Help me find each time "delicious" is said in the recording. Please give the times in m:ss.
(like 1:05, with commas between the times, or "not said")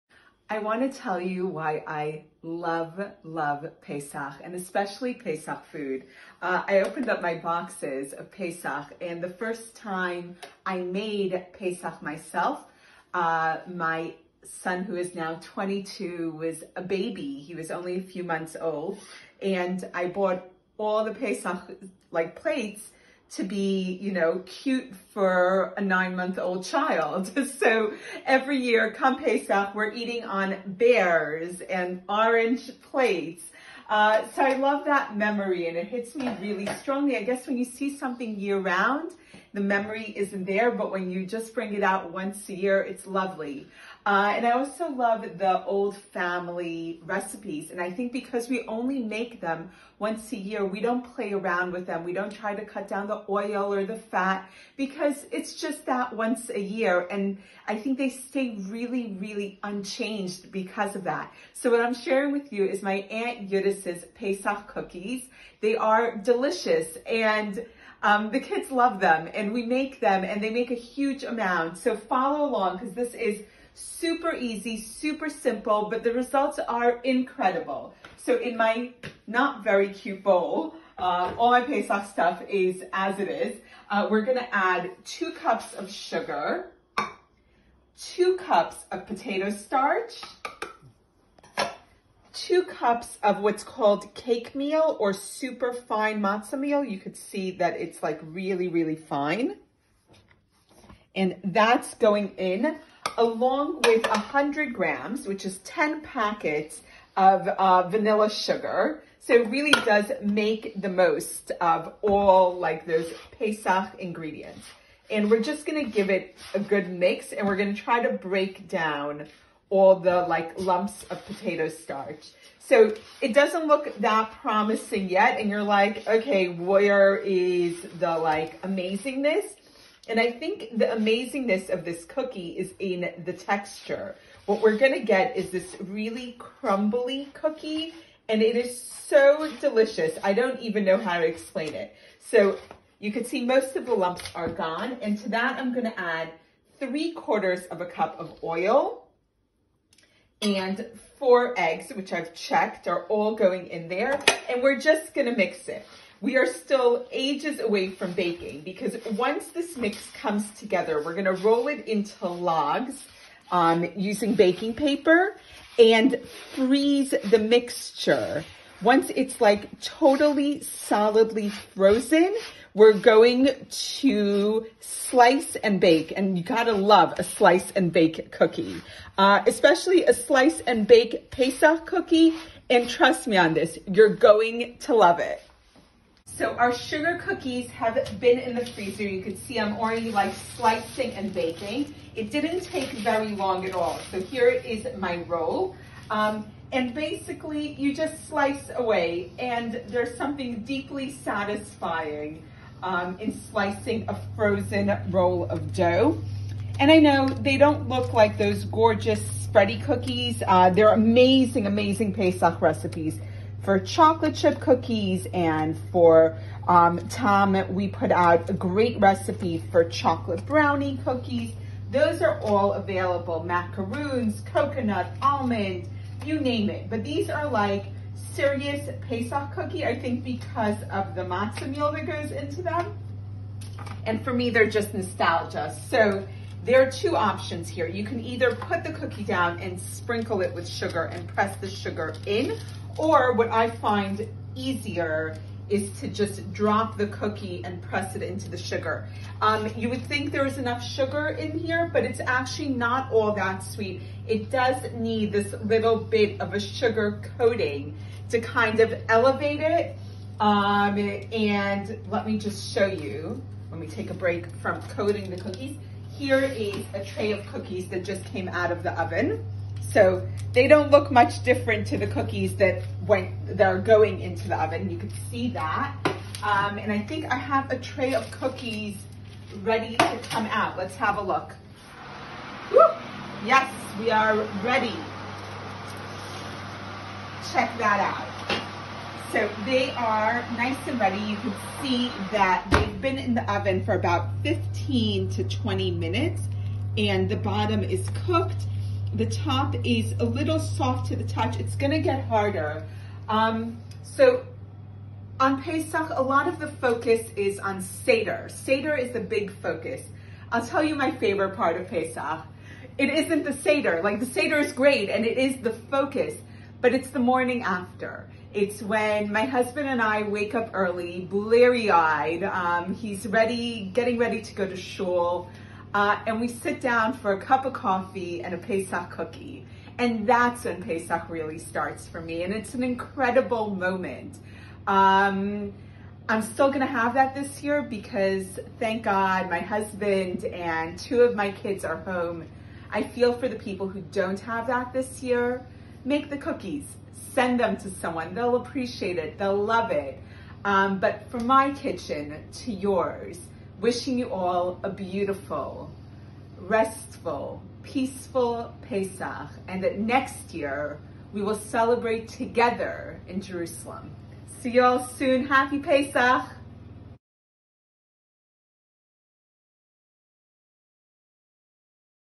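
1:06, 2:19.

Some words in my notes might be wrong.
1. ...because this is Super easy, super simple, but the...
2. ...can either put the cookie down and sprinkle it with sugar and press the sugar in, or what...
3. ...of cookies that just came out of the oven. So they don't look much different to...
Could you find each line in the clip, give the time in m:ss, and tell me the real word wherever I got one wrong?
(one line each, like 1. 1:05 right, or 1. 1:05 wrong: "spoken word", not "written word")
1. 1:12 right
2. 3:58 right
3. 4:27 right.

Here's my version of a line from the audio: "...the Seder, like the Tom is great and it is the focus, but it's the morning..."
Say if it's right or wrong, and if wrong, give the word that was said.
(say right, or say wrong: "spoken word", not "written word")
wrong: "Seder", not "Tom".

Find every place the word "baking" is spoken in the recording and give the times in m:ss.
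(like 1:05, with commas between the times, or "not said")
2:38, 2:44, 3:11.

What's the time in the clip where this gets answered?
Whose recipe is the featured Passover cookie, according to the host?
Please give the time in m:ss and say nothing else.
1:03.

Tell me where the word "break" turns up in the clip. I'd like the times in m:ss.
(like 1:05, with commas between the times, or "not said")
1:58, 4:24.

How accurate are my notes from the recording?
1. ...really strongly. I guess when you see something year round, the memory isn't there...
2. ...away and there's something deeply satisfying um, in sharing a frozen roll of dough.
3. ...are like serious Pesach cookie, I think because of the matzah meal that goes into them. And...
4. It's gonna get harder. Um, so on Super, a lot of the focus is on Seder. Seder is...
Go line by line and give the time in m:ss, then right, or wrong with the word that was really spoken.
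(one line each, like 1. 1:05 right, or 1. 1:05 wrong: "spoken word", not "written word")
1. 0:36 right
2. 3:18 wrong: "slicing", not "sharing"
3. 3:47 right
4. 5:01 wrong: "Pesach", not "Super".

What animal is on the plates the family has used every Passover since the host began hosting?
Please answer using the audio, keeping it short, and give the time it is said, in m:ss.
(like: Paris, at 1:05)
bears, at 0:30.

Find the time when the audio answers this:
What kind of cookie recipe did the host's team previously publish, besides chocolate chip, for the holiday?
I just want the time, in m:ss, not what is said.
3:39.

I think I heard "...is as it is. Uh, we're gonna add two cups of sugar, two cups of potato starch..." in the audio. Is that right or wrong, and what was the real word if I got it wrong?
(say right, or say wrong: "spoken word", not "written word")
right.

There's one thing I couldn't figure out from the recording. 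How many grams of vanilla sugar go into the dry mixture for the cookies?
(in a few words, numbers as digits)
100 grams.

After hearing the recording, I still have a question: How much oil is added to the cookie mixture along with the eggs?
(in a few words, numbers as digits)
3/4 cup.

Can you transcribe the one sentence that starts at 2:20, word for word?
I don't even know how to explain it.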